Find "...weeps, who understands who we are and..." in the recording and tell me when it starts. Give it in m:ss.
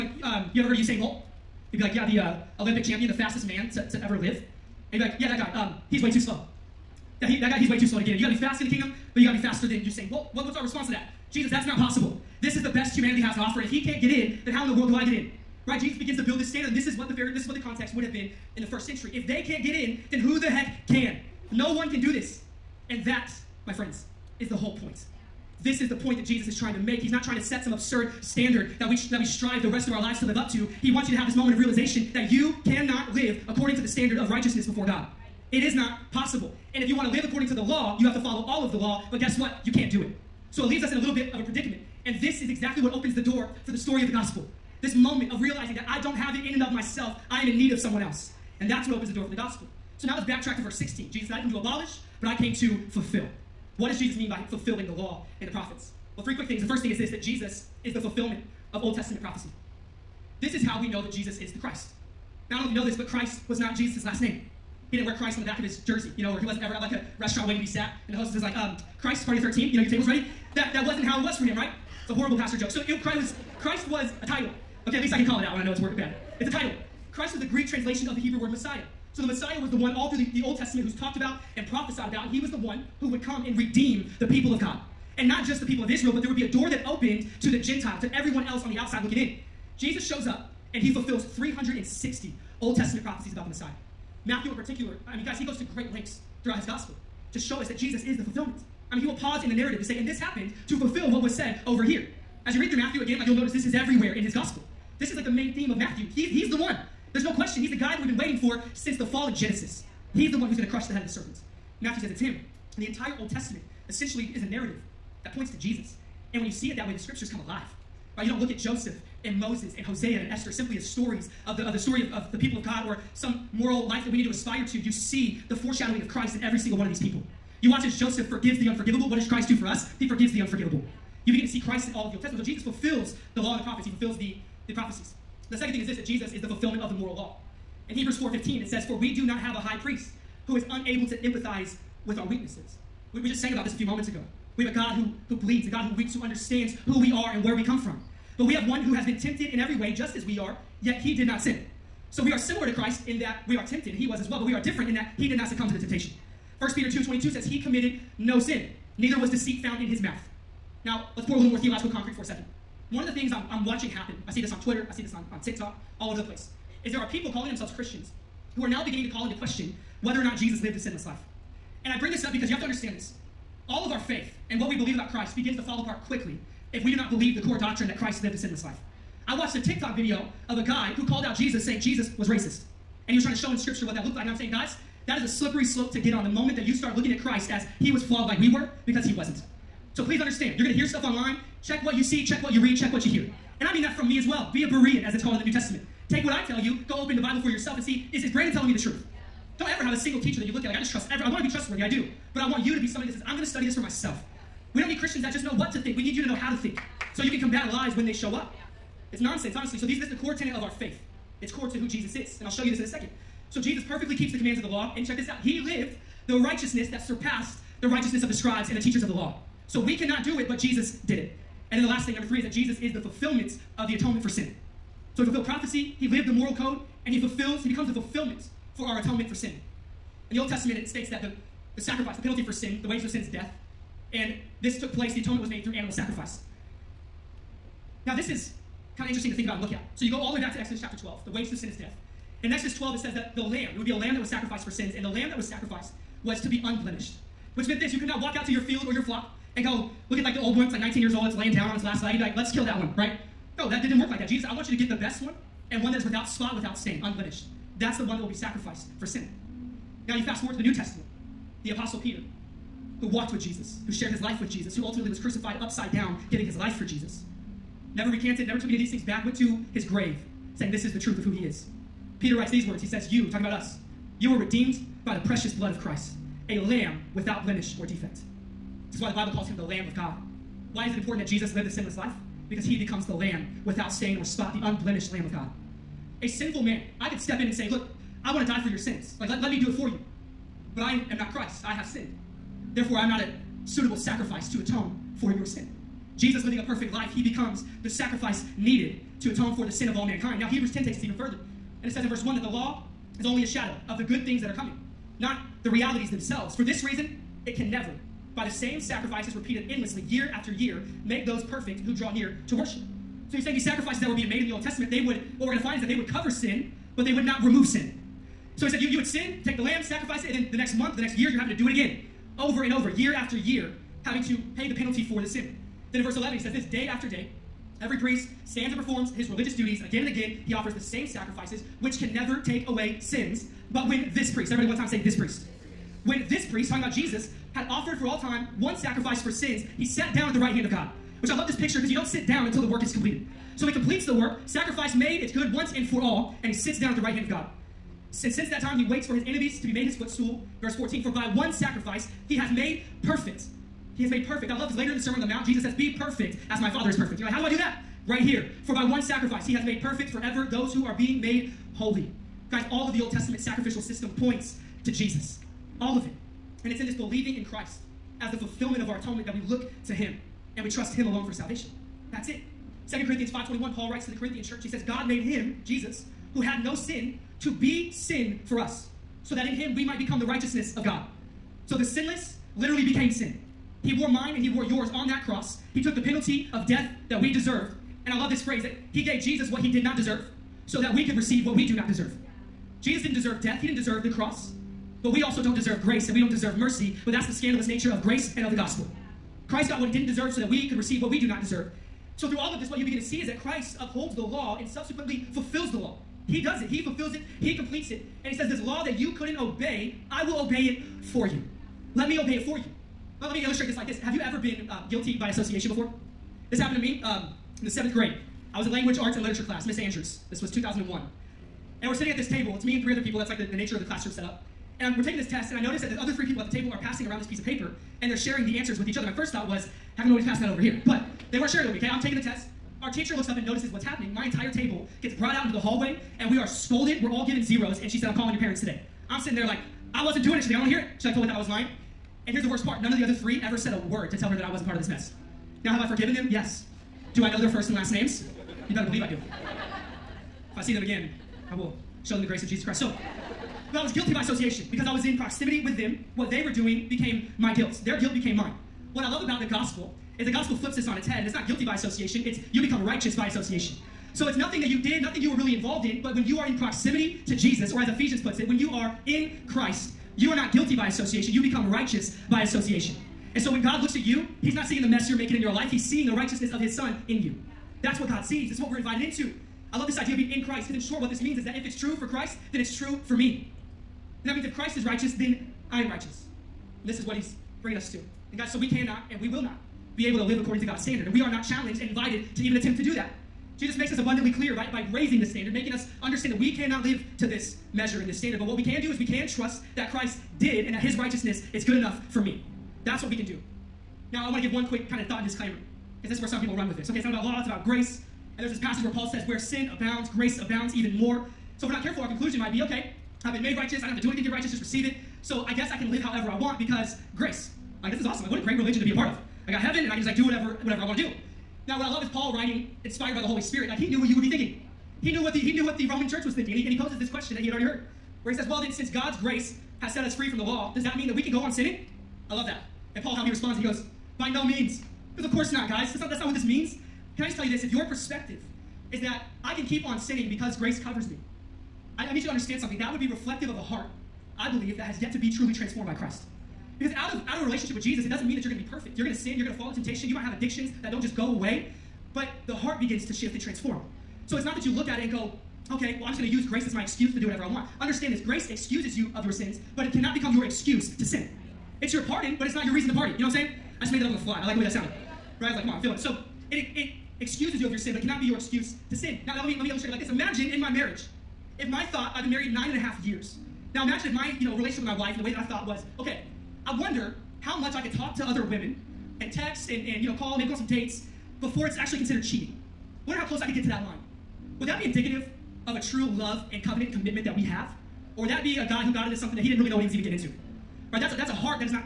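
2:25.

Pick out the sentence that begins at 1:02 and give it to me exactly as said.
Now, I don't know if you know this, but Christ was not Jesus' last name.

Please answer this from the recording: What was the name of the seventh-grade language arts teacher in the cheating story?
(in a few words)
Miss Andrews.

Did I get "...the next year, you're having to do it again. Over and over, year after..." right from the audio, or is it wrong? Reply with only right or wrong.
right.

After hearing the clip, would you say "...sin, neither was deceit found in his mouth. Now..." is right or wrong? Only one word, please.
right.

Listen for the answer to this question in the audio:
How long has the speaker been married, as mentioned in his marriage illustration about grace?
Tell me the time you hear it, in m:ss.
9:32.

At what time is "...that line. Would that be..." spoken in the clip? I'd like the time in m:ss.
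9:43.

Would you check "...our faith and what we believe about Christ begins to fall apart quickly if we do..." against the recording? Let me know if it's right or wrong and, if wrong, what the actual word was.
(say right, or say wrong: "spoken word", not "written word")
right.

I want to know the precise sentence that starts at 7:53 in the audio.
And so when God looks at you, He's not seeing the mess you're making in your life.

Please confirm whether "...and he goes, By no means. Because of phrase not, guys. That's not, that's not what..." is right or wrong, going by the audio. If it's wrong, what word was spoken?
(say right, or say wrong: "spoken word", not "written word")
wrong: "course", not "phrase".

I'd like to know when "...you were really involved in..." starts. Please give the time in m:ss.
7:45.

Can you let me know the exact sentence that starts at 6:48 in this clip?
And He says, This law that you couldn't obey, I will obey it for you.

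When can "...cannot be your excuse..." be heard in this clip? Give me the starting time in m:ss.
9:28.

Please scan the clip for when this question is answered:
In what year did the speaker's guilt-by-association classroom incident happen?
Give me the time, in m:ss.
7:00.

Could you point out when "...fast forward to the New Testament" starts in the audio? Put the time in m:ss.
4:20.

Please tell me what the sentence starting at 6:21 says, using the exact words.
So the sinless literally became sin.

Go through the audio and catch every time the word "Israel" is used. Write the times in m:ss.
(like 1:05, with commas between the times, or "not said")
1:25.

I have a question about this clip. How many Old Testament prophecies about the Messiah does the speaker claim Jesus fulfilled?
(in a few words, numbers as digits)
360.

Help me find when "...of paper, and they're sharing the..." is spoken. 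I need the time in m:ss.
7:07.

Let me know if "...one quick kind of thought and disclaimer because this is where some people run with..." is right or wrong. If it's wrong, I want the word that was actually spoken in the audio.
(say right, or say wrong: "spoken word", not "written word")
right.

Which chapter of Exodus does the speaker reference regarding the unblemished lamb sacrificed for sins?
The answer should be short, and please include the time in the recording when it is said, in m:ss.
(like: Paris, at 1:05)
Chapter 12, at 4:00.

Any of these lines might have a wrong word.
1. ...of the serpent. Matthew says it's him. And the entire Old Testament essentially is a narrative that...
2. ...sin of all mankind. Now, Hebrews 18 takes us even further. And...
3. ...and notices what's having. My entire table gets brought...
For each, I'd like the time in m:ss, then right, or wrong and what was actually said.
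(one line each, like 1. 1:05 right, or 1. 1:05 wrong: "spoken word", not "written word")
1. 1:51 right
2. 4:59 wrong: "10", not "18"
3. 7:13 wrong: "happening", not "having".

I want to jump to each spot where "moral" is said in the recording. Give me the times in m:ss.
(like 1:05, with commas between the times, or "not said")
2:03, 2:16, 3:46.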